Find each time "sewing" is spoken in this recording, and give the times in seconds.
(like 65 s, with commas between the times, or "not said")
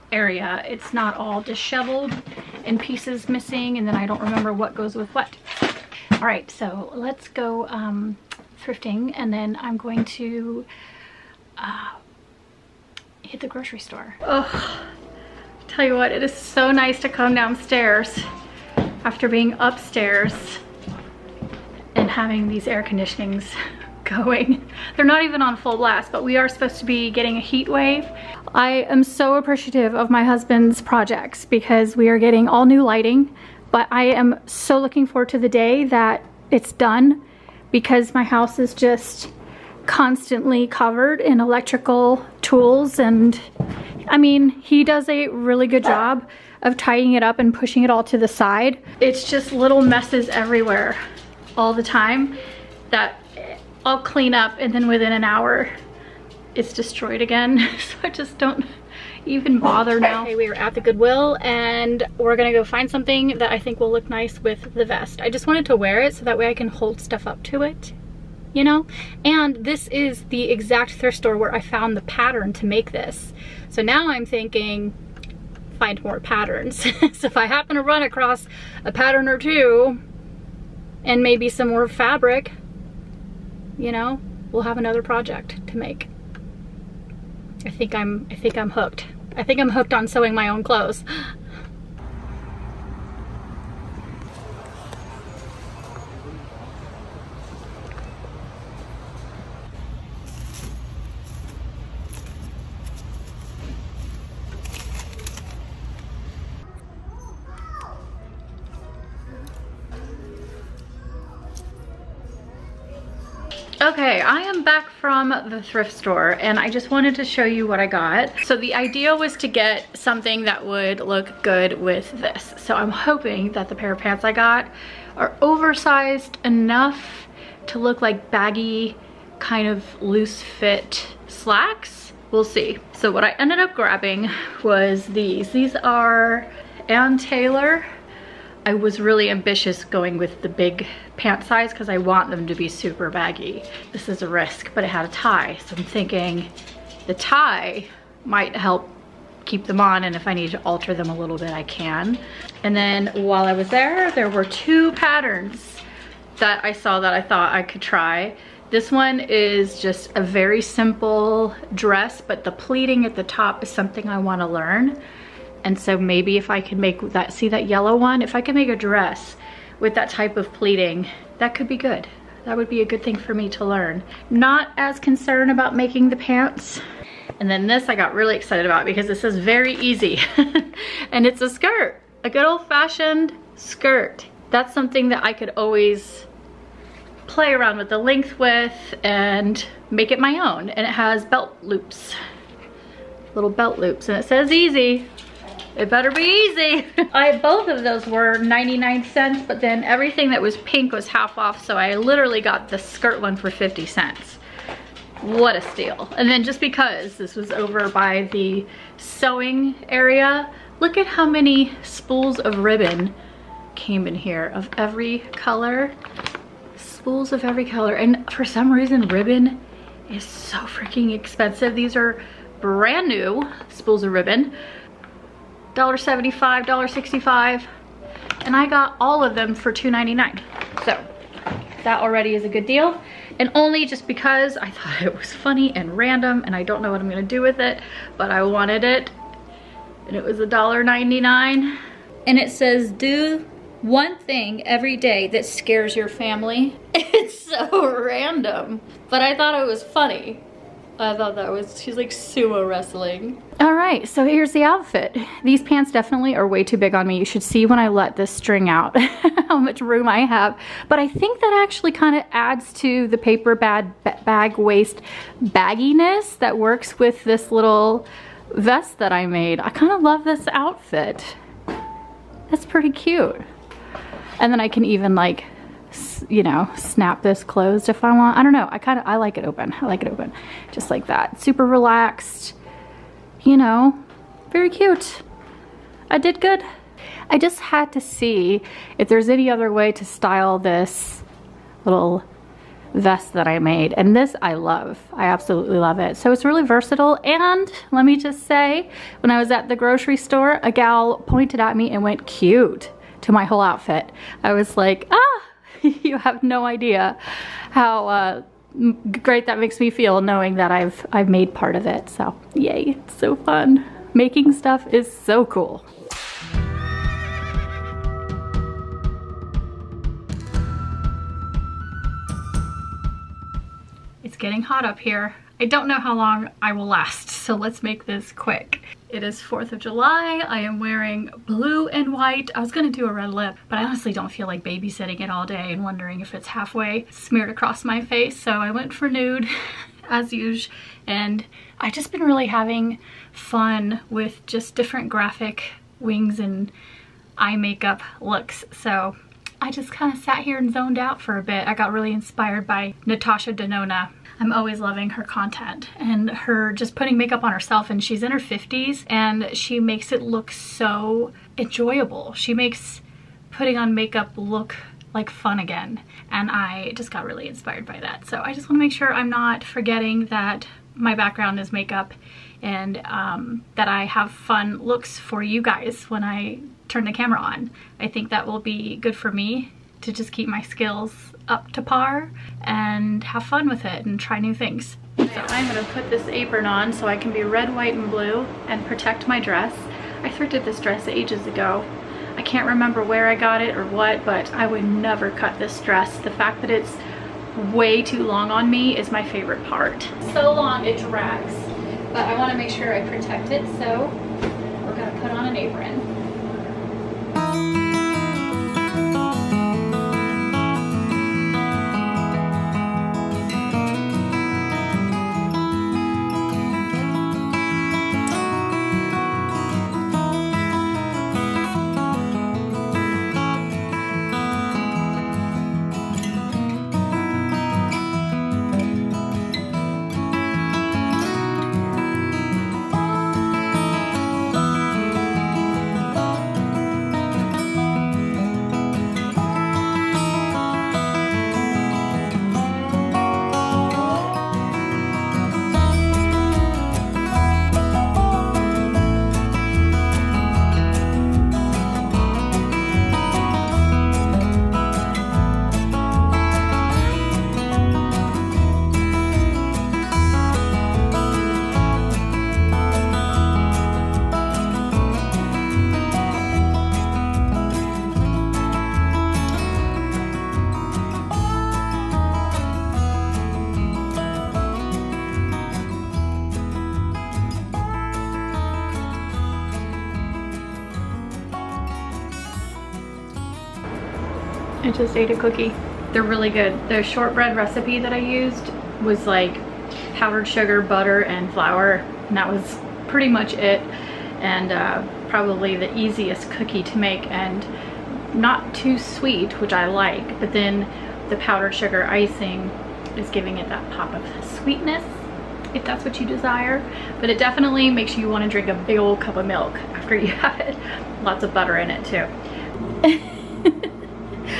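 90 s, 208 s.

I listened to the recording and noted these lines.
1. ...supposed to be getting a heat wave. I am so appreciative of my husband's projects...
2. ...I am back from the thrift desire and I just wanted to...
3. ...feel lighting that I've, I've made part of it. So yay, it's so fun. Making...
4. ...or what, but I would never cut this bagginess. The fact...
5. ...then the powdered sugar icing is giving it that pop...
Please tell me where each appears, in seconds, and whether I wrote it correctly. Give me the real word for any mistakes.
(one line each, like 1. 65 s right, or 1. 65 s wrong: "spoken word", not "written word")
1. 26 s right
2. 114 s wrong: "store", not "desire"
3. 309 s wrong: "knowing", not "lighting"
4. 393 s wrong: "dress", not "bagginess"
5. 500 s right.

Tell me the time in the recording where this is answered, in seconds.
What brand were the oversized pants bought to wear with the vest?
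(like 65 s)
136 s.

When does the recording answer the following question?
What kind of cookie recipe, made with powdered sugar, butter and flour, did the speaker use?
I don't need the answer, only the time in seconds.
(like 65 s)
487 s.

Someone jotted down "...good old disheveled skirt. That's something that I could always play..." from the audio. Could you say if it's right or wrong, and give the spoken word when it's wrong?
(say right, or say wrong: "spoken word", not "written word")
wrong: "fashioned", not "disheveled".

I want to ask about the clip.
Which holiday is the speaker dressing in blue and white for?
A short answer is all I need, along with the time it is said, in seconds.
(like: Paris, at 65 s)
4th of July, at 329 s.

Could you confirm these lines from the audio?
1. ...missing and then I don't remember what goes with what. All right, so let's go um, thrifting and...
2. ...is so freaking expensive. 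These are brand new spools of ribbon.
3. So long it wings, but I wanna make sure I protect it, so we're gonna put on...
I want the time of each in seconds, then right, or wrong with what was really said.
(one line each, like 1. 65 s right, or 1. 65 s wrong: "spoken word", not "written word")
1. 3 s right
2. 220 s right
3. 400 s wrong: "drags", not "wings".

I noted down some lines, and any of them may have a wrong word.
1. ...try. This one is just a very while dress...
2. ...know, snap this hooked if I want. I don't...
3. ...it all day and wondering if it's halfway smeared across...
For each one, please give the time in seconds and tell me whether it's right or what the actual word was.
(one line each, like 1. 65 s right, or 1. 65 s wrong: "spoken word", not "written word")
1. 157 s wrong: "simple", not "while"
2. 276 s wrong: "closed", not "hooked"
3. 335 s right.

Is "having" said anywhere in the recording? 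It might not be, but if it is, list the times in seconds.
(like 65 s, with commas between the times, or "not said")
22 s, 342 s.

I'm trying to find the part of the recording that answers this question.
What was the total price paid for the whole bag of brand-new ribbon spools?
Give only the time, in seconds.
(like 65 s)
229 s.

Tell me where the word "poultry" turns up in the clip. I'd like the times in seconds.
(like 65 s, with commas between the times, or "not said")
not said.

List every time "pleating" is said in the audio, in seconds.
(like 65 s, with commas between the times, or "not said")
162 s, 170 s.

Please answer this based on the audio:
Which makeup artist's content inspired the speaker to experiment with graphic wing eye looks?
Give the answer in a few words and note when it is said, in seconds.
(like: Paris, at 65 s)
Natasha Denona, at 353 s.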